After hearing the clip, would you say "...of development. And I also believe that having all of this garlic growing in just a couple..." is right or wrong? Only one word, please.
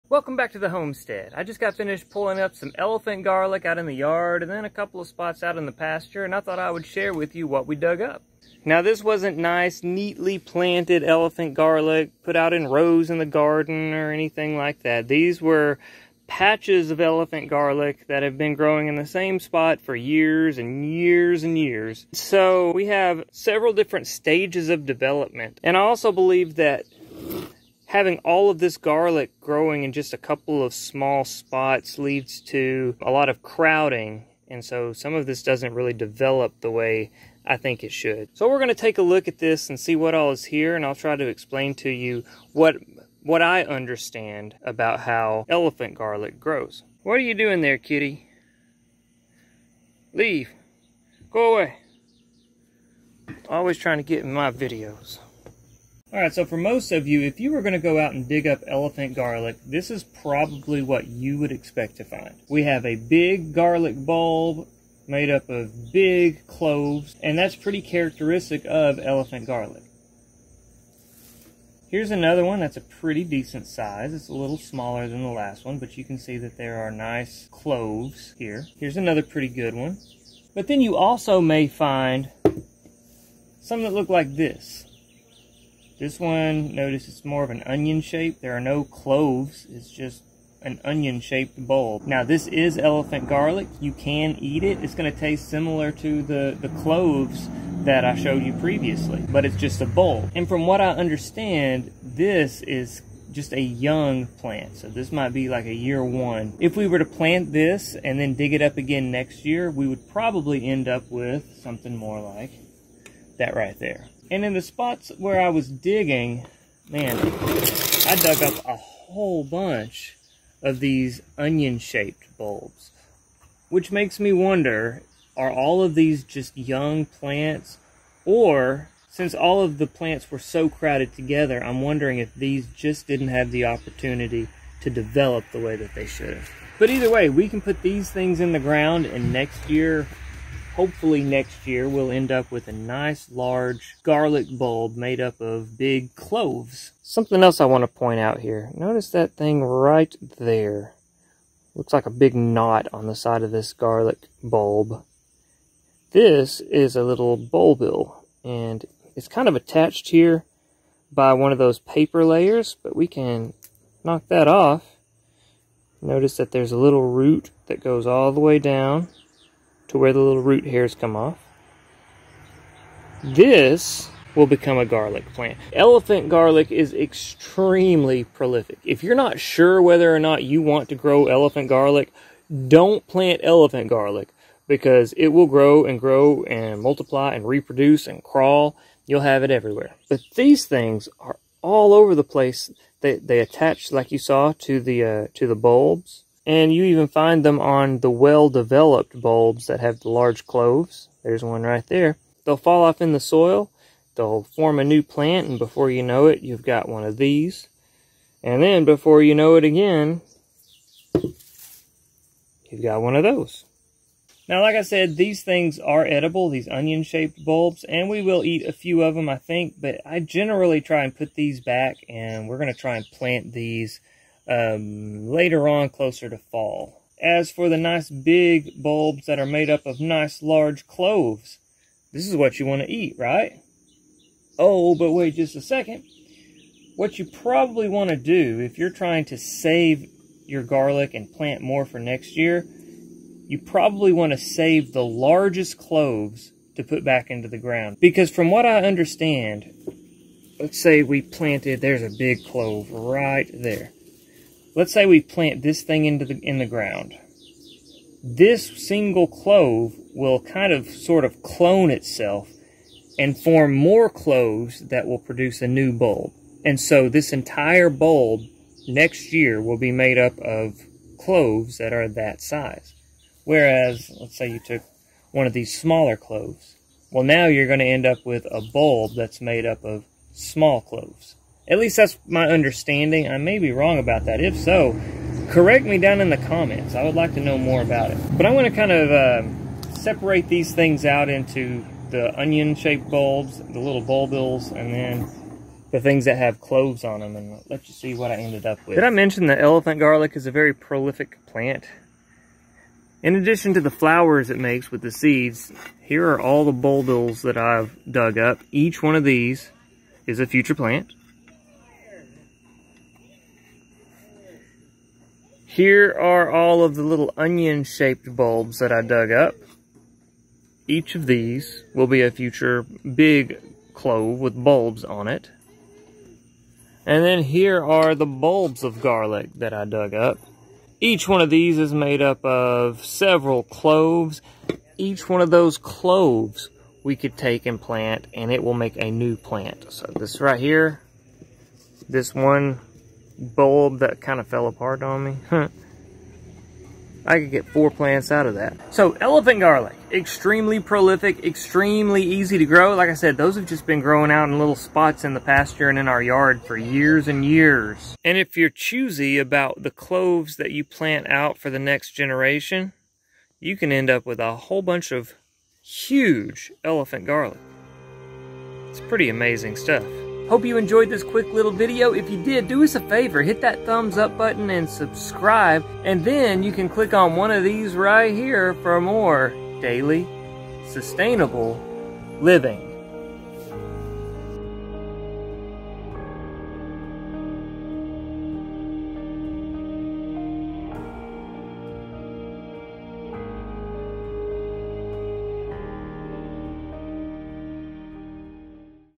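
right.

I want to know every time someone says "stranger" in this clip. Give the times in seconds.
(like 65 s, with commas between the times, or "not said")
not said.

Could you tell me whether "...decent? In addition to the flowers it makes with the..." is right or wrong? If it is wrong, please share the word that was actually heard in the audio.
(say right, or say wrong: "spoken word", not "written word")
wrong: "plant", not "decent".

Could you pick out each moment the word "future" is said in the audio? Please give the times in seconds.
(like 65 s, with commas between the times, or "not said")
310 s, 322 s.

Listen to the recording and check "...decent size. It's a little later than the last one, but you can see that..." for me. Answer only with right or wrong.
wrong.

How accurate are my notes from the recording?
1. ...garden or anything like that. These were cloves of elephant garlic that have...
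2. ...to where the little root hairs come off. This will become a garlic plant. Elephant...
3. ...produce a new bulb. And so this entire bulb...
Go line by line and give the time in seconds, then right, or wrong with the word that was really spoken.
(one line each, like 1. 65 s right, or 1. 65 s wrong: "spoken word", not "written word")
1. 13 s wrong: "patches", not "cloves"
2. 169 s right
3. 265 s right.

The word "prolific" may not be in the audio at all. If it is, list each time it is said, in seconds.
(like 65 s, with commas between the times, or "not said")
178 s, 300 s, 350 s.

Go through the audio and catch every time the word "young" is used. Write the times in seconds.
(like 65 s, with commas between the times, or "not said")
103 s, 126 s.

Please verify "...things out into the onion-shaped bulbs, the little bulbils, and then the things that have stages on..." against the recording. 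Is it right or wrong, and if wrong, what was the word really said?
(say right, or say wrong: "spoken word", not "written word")
wrong: "cloves", not "stages".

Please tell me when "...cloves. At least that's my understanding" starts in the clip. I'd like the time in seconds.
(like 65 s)
280 s.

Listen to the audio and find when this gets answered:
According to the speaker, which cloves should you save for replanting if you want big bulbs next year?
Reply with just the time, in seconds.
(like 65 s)
244 s.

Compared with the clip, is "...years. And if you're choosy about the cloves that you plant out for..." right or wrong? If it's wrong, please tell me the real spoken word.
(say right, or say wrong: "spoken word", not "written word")
right.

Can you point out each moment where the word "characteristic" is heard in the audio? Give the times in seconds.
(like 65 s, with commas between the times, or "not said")
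67 s.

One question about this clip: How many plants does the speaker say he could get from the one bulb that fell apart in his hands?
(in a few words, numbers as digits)
4.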